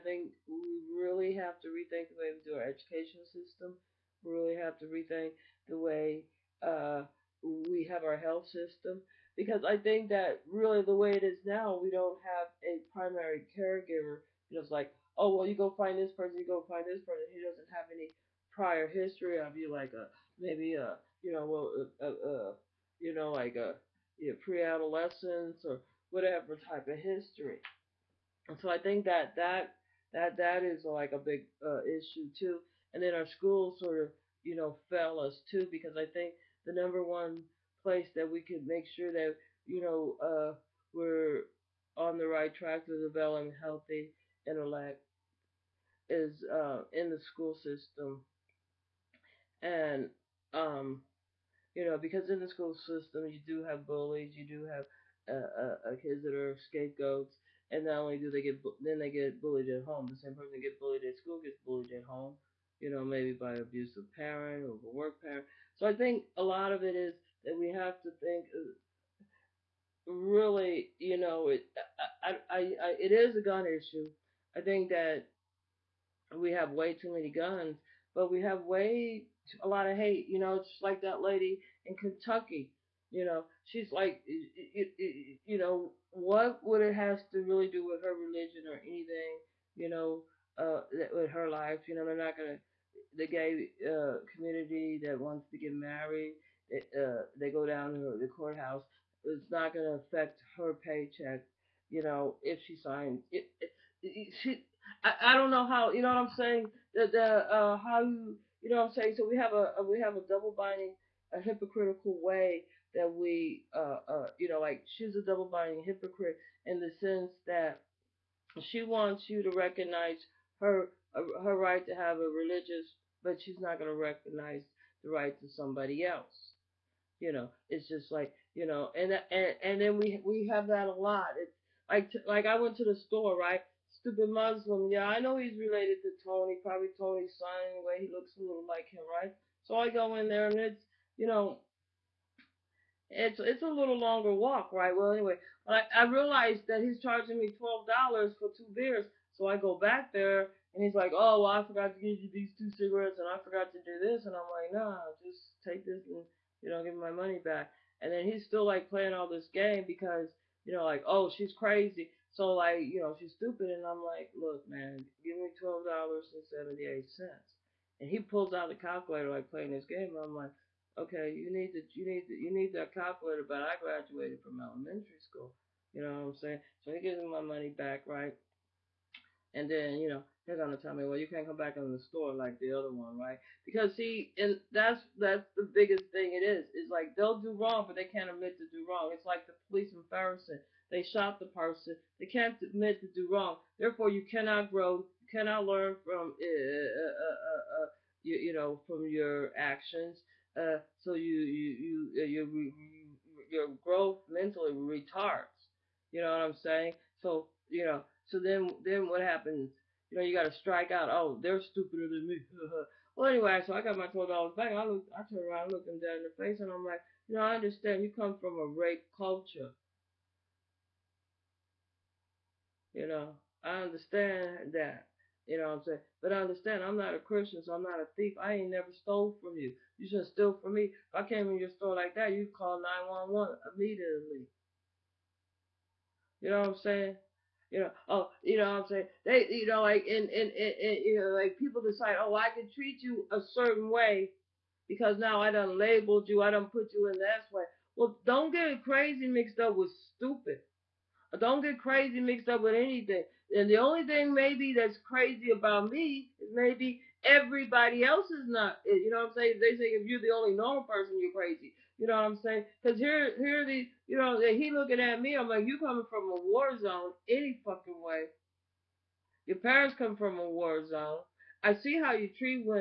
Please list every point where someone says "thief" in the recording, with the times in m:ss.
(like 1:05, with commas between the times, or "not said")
3:48.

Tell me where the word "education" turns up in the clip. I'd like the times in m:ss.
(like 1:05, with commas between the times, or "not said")
0:02.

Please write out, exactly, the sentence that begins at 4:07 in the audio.
Well, don't get crazy mixed up with stupid.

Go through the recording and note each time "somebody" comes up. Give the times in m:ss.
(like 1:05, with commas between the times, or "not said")
2:05.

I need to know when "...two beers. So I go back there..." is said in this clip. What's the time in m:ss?
2:28.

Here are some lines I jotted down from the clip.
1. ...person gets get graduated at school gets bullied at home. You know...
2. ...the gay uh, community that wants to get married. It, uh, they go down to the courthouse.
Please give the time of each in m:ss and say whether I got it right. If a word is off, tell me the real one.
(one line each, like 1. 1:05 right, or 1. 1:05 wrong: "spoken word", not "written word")
1. 1:00 wrong: "bullied", not "graduated"
2. 1:33 right.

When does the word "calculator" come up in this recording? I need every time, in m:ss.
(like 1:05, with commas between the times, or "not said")
2:48, 2:52.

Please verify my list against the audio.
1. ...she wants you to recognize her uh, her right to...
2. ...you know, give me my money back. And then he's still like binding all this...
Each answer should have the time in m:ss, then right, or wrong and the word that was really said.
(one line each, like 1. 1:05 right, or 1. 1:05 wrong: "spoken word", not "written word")
1. 1:58 right
2. 2:36 wrong: "playing", not "binding".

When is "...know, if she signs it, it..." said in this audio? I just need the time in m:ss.
1:42.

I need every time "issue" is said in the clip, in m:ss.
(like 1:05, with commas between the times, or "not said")
0:31, 1:13.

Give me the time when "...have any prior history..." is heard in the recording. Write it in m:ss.
0:17.